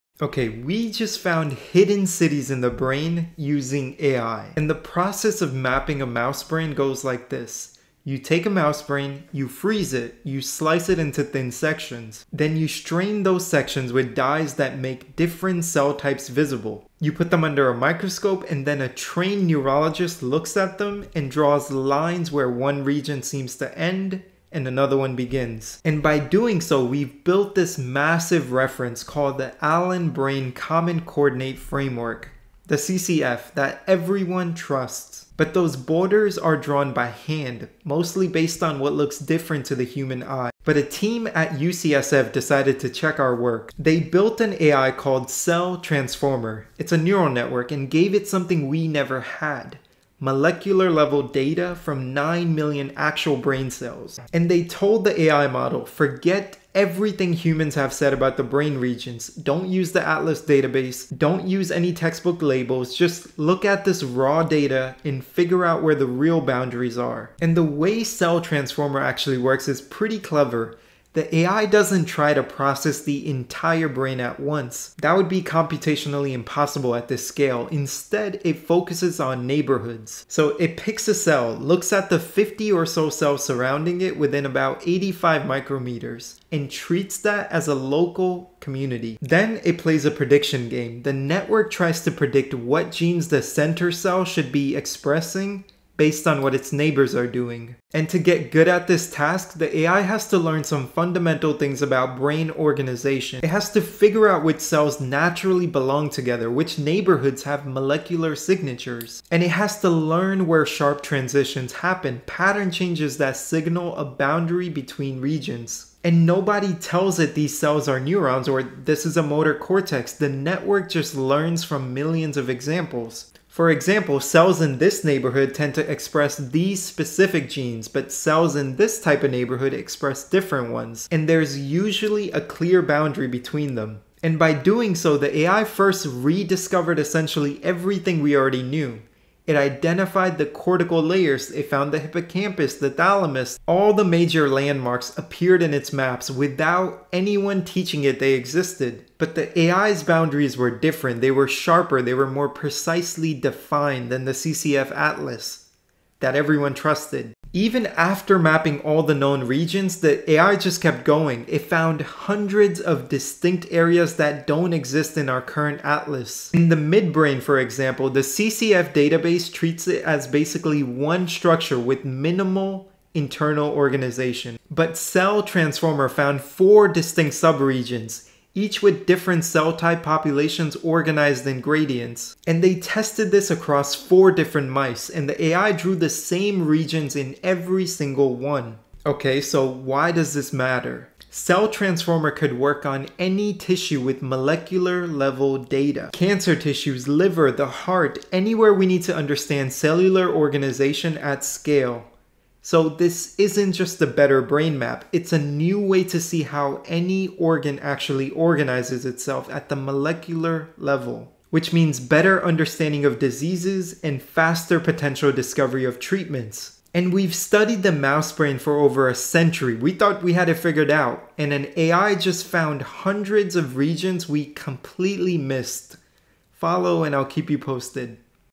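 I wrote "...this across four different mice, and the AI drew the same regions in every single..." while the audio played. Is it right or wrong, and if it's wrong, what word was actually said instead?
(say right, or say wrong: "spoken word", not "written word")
right.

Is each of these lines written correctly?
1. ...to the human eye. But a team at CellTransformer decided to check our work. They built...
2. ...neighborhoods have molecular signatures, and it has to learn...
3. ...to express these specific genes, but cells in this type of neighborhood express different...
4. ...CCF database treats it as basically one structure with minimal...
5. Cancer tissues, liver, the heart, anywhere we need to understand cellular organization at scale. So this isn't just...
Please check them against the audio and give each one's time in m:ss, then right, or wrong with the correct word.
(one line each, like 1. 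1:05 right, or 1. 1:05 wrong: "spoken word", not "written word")
1. 0:39 wrong: "UCSF", not "CellTransformer"
2. 1:46 right
3. 2:05 right
4. 2:48 right
5. 3:16 right.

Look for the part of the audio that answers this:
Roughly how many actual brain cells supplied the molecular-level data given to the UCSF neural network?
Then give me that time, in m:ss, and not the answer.
0:52.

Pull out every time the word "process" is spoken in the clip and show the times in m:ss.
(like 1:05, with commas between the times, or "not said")
0:04, 1:12.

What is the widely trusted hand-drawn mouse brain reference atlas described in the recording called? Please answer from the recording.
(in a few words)
Allen Brain Common Coordinate Framework.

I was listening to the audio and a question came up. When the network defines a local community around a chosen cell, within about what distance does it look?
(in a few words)
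85 micrometers.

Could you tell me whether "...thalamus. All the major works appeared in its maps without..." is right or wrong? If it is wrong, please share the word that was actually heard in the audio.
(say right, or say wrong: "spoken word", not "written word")
wrong: "landmarks", not "works".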